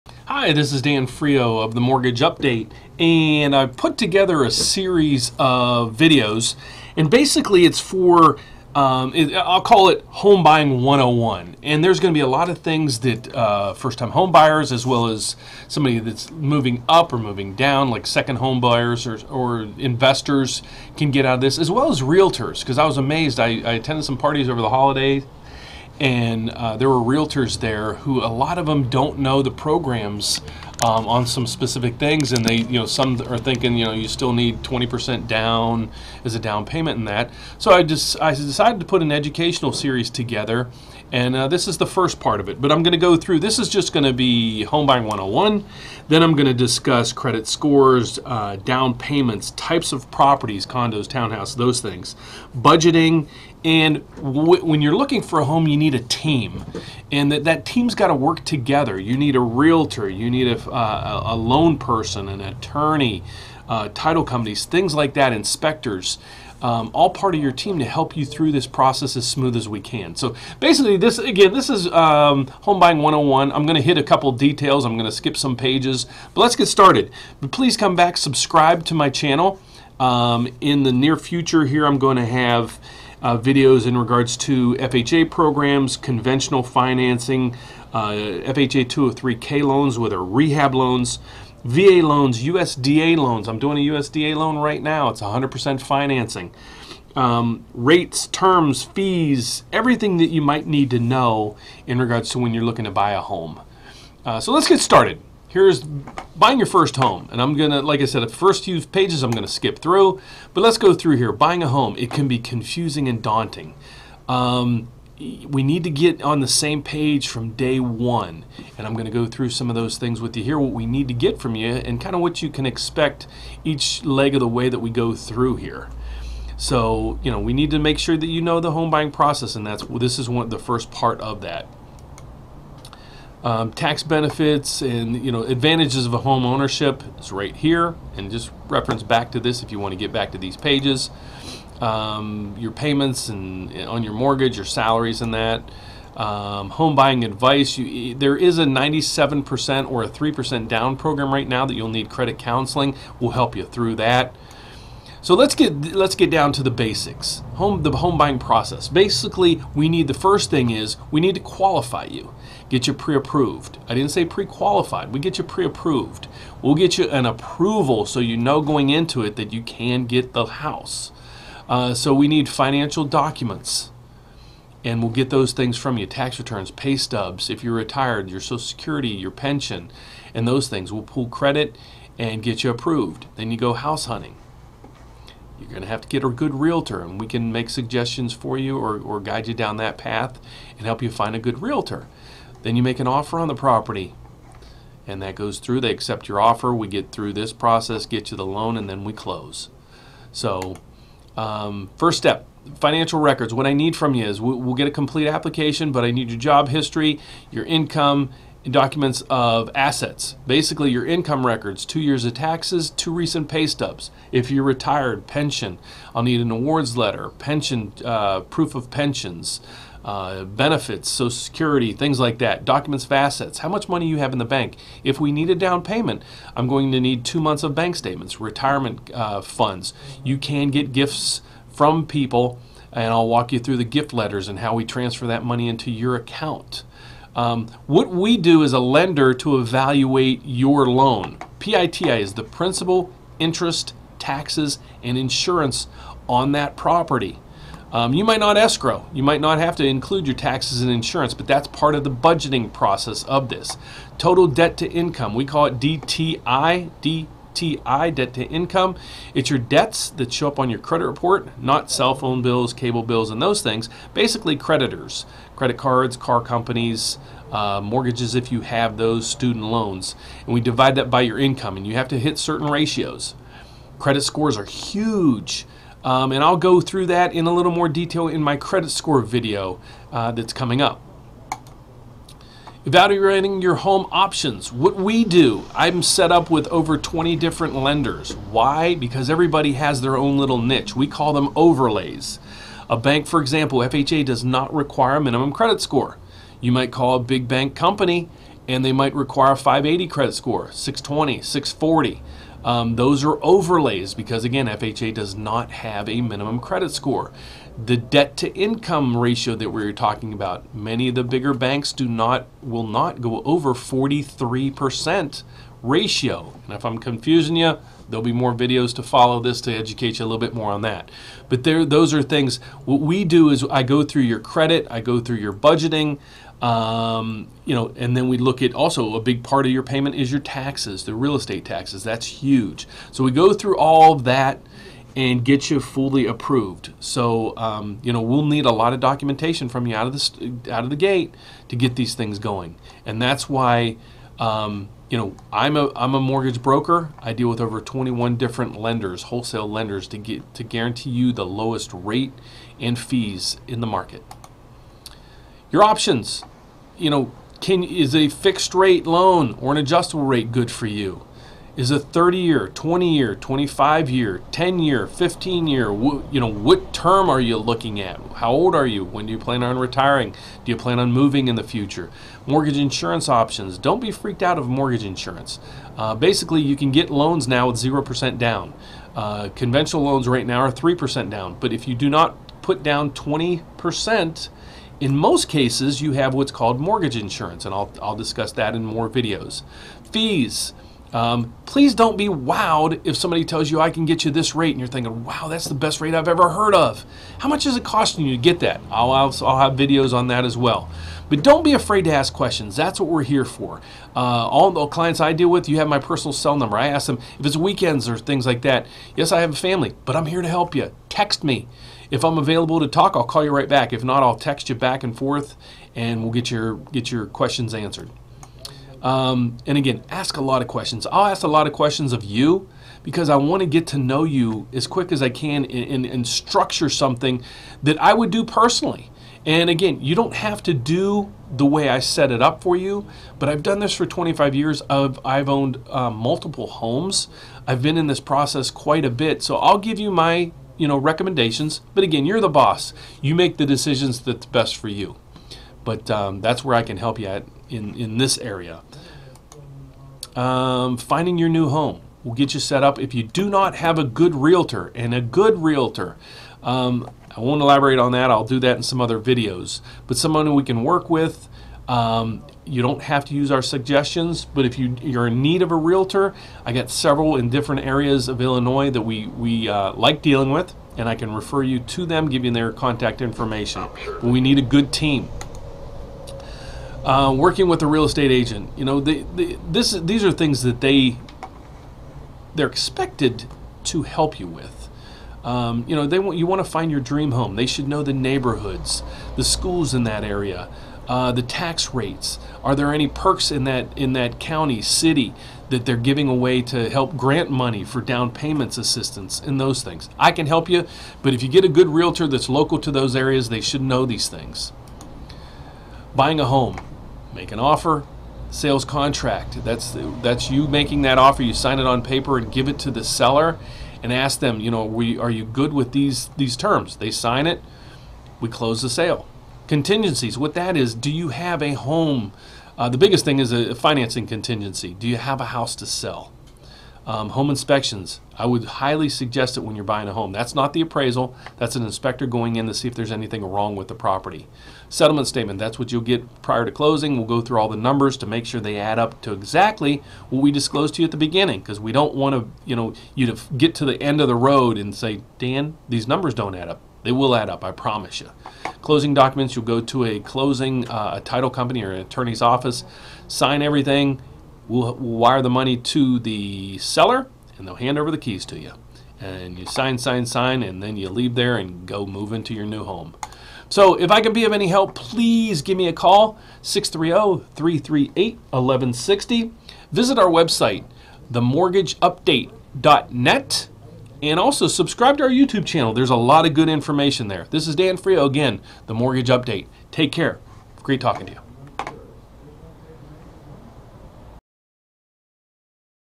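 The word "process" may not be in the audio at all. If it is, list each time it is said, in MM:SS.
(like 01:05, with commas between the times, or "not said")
01:08, 02:09, 02:38, 03:17, 04:12, 07:18.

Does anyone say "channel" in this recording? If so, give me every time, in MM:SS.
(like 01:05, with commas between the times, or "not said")
01:19, 09:35.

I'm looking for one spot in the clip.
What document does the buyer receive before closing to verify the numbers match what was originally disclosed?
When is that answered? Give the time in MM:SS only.
08:54.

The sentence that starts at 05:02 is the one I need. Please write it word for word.
Um, those are overlays because, again, FHA does not have a minimum credit score.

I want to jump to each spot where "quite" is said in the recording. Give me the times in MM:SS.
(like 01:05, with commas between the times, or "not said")
07:18.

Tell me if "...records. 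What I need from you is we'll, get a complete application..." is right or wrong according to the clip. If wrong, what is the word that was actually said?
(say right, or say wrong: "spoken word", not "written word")
right.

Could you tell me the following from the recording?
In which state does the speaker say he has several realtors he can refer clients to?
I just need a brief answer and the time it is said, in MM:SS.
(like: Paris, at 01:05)
Illinois, at 07:48.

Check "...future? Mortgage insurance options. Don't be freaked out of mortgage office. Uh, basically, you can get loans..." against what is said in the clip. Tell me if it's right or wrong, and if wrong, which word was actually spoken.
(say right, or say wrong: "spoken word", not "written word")
wrong: "insurance", not "office".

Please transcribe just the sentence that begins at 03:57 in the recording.
Um, what we do as a lender to evaluate your loan, PITI is the principal, interest, taxes, and insurance on that property.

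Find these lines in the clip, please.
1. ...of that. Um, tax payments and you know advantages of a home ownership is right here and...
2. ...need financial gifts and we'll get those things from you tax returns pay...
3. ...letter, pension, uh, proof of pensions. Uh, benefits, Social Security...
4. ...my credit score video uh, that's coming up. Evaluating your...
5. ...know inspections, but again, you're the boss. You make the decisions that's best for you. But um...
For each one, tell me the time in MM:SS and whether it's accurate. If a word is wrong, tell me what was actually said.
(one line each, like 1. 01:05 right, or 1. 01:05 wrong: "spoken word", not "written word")
1. 02:11 wrong: "benefits", not "payments"
2. 02:52 wrong: "documents", not "gifts"
3. 03:36 right
4. 04:38 right
5. 07:20 wrong: "recommendations", not "inspections".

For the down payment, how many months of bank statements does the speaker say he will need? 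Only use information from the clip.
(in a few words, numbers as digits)
2 months.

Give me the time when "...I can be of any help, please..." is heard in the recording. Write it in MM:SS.
09:24.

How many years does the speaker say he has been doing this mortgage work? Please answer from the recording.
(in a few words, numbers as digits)
25 years.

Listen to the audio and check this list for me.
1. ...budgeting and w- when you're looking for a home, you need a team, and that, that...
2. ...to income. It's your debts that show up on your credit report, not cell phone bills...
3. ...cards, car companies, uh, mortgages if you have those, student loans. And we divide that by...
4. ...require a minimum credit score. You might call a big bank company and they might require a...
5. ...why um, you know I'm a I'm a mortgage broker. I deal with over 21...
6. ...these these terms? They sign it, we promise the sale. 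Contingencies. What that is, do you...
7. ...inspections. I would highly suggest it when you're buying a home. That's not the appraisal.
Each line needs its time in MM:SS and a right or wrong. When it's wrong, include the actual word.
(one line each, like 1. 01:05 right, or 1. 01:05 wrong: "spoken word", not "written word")
1. 00:52 right
2. 04:18 right
3. 04:25 right
4. 04:54 right
5. 05:43 right
6. 08:35 wrong: "close", not "promise"
7. 08:47 right.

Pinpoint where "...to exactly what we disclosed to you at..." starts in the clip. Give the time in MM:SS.
08:59.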